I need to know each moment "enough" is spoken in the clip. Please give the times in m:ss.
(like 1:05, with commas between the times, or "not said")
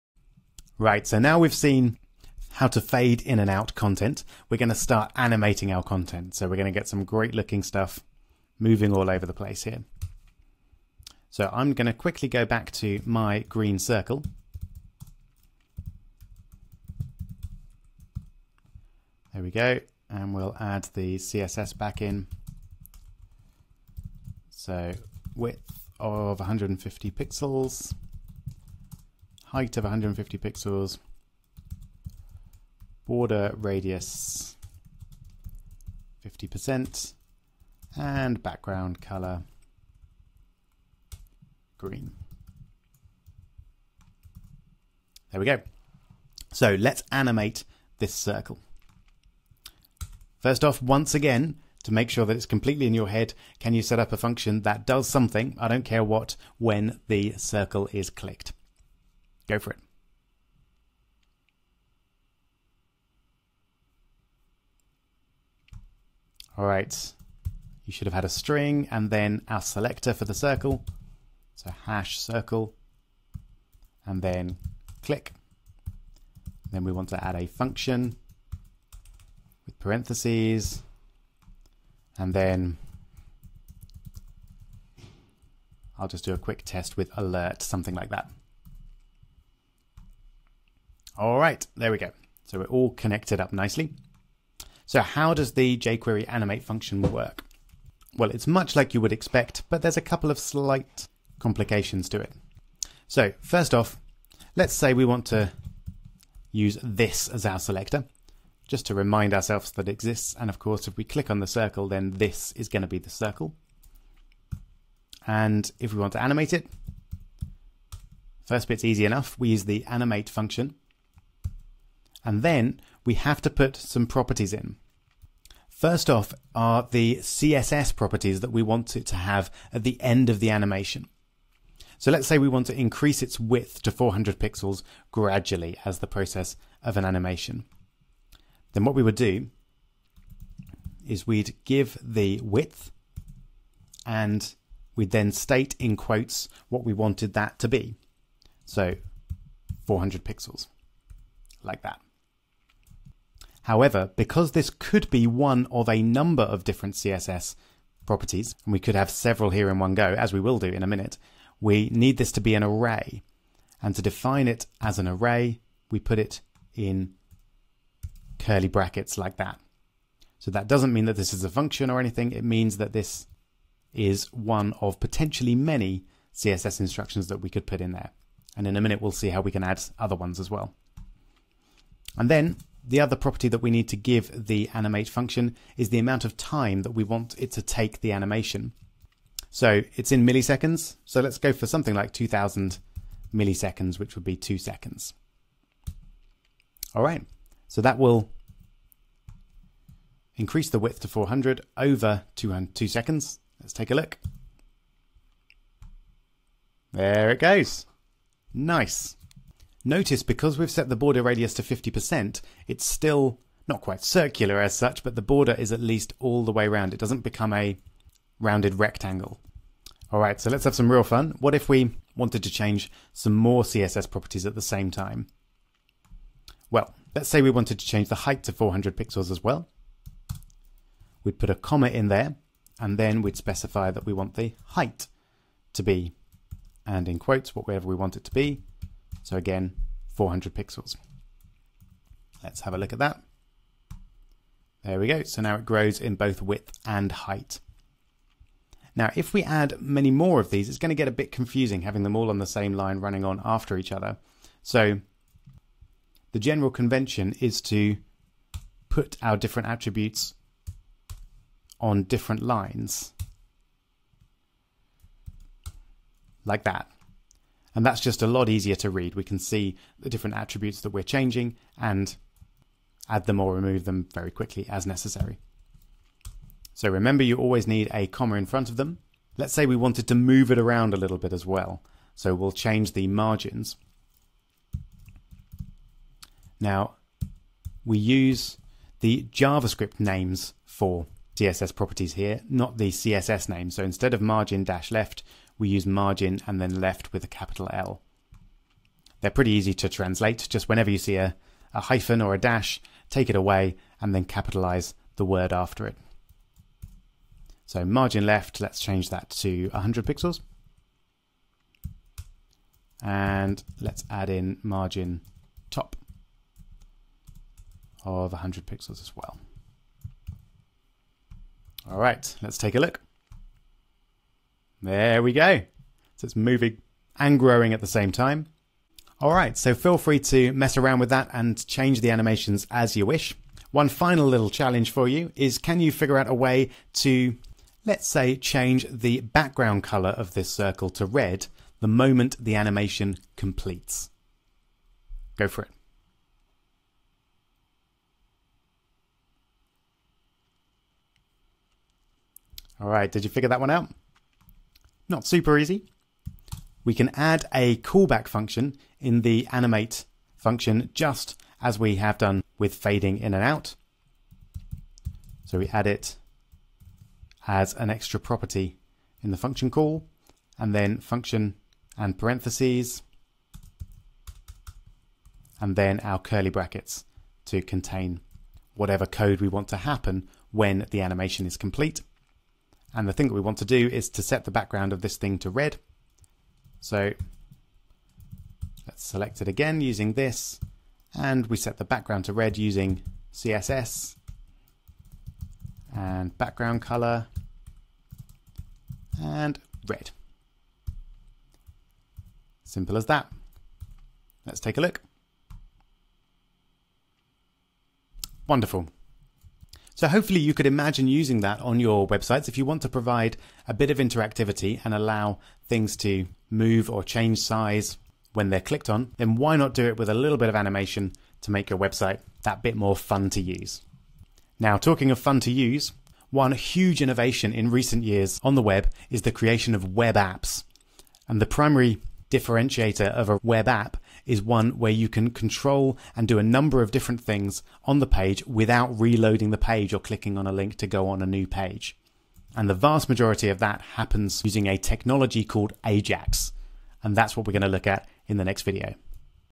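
1:59.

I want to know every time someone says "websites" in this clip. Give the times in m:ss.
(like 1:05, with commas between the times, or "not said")
6:52, 7:01.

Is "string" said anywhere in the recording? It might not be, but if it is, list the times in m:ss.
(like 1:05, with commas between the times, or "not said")
1:08.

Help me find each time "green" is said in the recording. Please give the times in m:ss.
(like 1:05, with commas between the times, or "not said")
0:13, 0:41.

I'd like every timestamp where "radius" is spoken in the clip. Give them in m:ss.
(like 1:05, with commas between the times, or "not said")
0:33, 3:31.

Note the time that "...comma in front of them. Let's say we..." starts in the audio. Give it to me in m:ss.
4:38.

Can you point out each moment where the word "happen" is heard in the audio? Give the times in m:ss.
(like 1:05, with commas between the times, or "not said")
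6:19, 7:23.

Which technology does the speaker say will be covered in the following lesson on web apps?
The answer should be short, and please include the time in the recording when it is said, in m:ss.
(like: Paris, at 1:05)
Ajax, at 7:25.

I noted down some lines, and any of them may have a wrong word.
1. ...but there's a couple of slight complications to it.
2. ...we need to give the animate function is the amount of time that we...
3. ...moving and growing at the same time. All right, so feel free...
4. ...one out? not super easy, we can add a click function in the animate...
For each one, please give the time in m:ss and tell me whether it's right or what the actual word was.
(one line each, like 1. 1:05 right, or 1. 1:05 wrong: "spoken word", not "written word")
1. 1:39 right
2. 3:03 right
3. 5:26 right
4. 5:53 wrong: "callback", not "click".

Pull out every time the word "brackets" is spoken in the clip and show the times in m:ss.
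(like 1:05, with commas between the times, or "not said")
2:48, 6:16.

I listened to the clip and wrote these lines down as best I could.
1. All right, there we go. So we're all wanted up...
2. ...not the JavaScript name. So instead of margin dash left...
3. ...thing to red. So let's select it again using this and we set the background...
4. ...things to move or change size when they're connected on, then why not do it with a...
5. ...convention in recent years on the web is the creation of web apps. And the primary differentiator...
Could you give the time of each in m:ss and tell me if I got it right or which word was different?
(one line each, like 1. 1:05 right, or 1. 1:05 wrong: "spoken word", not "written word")
1. 1:31 wrong: "connected", not "wanted"
2. 4:52 wrong: "CSS", not "JavaScript"
3. 6:25 right
4. 6:55 wrong: "clicked", not "connected"
5. 7:07 wrong: "innovation", not "convention".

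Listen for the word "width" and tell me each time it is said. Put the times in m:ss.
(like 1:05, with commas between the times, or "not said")
0:25, 2:13, 2:22, 3:20, 4:06.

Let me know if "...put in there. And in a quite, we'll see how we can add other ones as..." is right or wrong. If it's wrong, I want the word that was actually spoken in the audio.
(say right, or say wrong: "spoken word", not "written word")
wrong: "minute", not "quite".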